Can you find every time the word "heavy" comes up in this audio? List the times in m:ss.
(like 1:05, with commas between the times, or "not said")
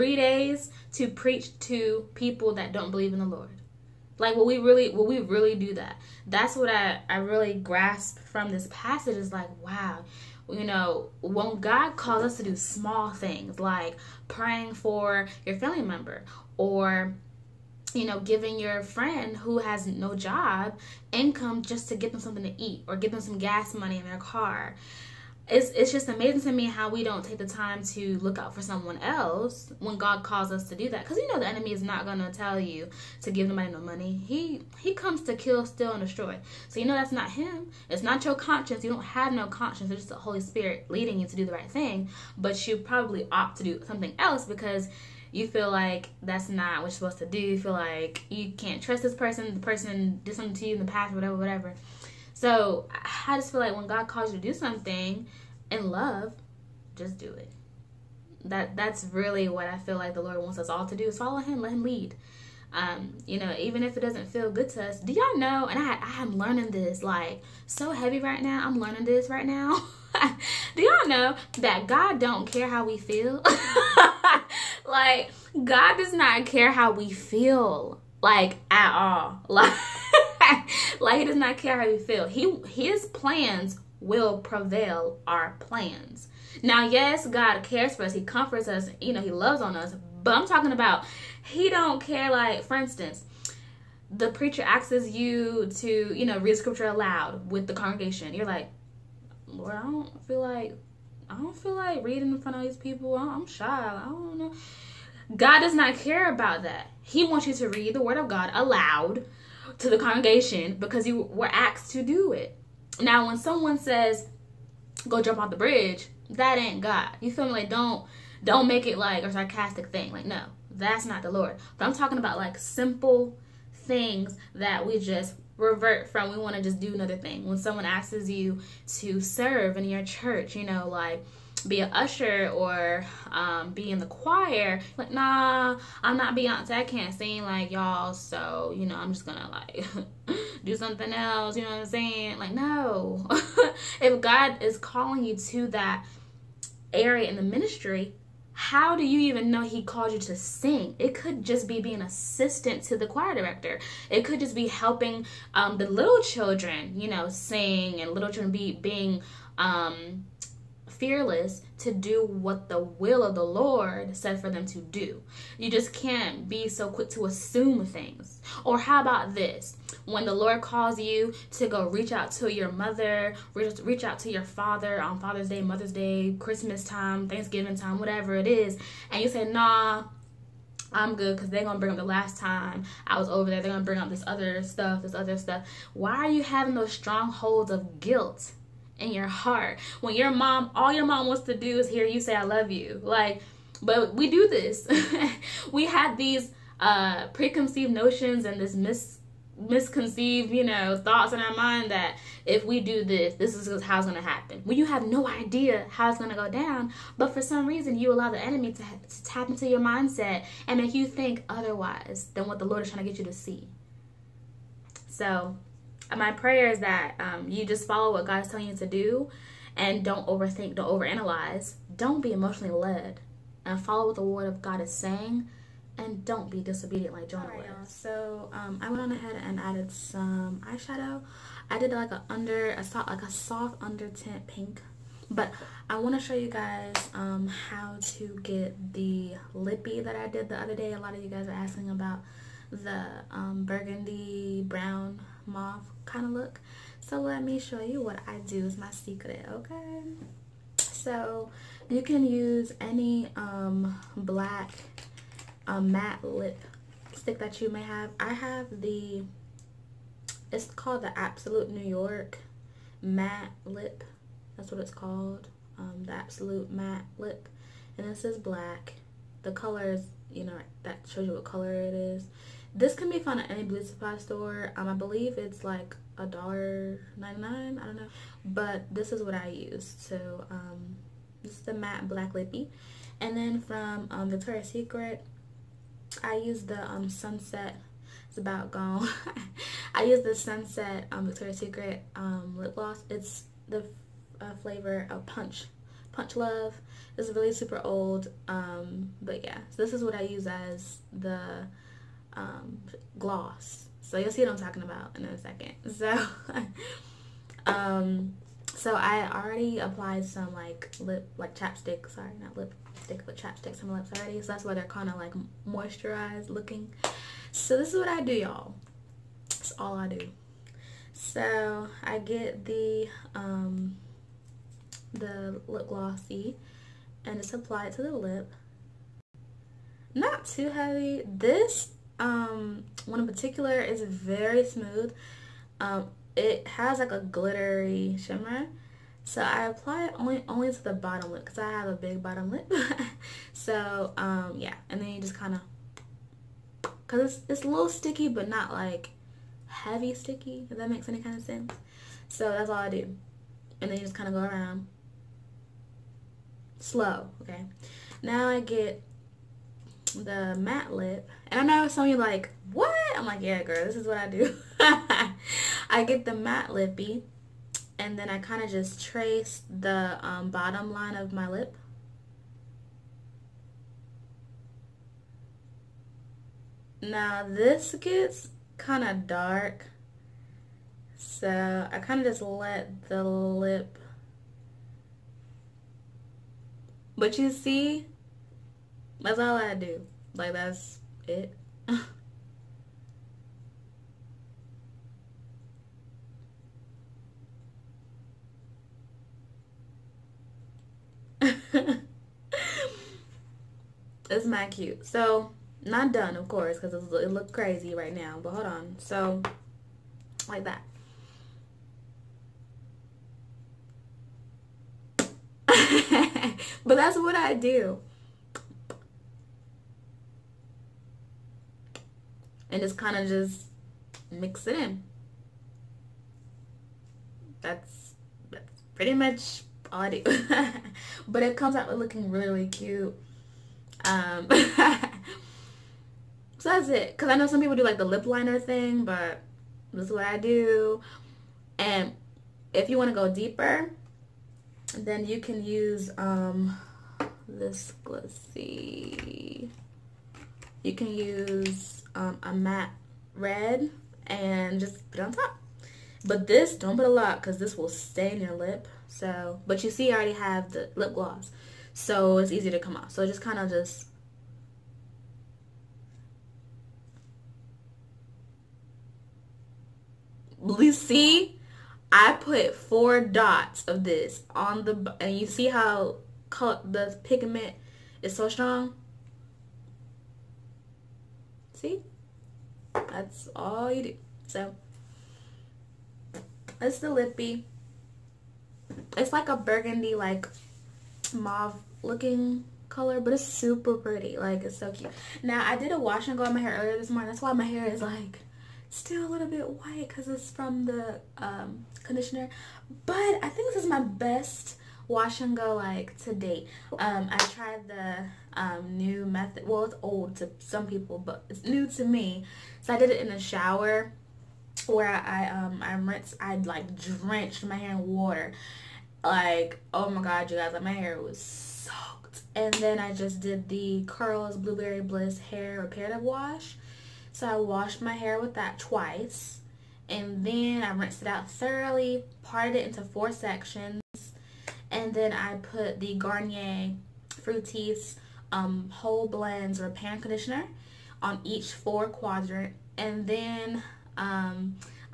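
1:07, 5:30, 5:49.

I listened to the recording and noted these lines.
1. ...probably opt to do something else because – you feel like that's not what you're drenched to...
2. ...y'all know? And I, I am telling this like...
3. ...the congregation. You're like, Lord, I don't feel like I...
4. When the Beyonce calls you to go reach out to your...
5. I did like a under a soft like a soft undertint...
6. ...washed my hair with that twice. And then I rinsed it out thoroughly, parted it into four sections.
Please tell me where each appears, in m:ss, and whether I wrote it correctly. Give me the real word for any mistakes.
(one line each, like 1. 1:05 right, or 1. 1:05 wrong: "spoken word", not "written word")
1. 0:42 wrong: "supposed", not "drenched"
2. 1:05 wrong: "learning", not "telling"
3. 1:37 right
4. 2:50 wrong: "Lord", not "Beyonce"
5. 3:51 right
6. 8:47 right.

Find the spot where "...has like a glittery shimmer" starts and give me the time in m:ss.
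5:36.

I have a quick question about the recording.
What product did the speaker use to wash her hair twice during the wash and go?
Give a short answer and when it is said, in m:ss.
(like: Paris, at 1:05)
Curls Blueberry Bliss Hair Reparative Wash, at 8:44.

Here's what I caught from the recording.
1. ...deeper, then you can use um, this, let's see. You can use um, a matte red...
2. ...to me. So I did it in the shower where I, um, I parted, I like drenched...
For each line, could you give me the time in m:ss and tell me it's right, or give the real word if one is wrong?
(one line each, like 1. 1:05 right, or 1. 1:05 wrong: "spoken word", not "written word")
1. 7:23 right
2. 8:31 wrong: "rinsed", not "parted".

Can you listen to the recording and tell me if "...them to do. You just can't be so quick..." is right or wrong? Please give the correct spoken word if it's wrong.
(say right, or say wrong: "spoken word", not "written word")
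right.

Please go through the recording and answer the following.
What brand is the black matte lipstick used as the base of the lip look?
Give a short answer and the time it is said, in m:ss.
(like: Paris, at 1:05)
Absolute New York, at 4:21.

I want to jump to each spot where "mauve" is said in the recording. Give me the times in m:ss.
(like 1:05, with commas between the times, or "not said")
4:05, 8:11.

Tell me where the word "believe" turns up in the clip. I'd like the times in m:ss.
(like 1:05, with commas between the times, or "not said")
0:02, 4:34.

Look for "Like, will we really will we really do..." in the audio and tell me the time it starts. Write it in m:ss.
0:04.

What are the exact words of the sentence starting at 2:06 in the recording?
We want to just do another thing.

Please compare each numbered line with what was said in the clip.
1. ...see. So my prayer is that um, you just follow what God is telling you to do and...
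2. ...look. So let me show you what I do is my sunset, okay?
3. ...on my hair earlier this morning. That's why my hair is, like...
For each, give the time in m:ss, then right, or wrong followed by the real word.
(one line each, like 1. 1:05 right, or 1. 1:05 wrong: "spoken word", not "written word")
1. 3:33 right
2. 4:06 wrong: "secret", not "sunset"
3. 8:16 right.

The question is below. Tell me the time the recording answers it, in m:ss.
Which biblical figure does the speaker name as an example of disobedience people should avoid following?
3:47.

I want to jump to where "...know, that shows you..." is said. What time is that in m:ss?
4:30.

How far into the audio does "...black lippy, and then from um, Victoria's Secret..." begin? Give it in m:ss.
4:42.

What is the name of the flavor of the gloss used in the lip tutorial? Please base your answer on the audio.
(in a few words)
Punch Love.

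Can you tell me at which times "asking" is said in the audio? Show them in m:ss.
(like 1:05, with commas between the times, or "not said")
4:01.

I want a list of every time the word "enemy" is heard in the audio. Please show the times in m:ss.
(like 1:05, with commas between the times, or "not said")
0:31, 3:28.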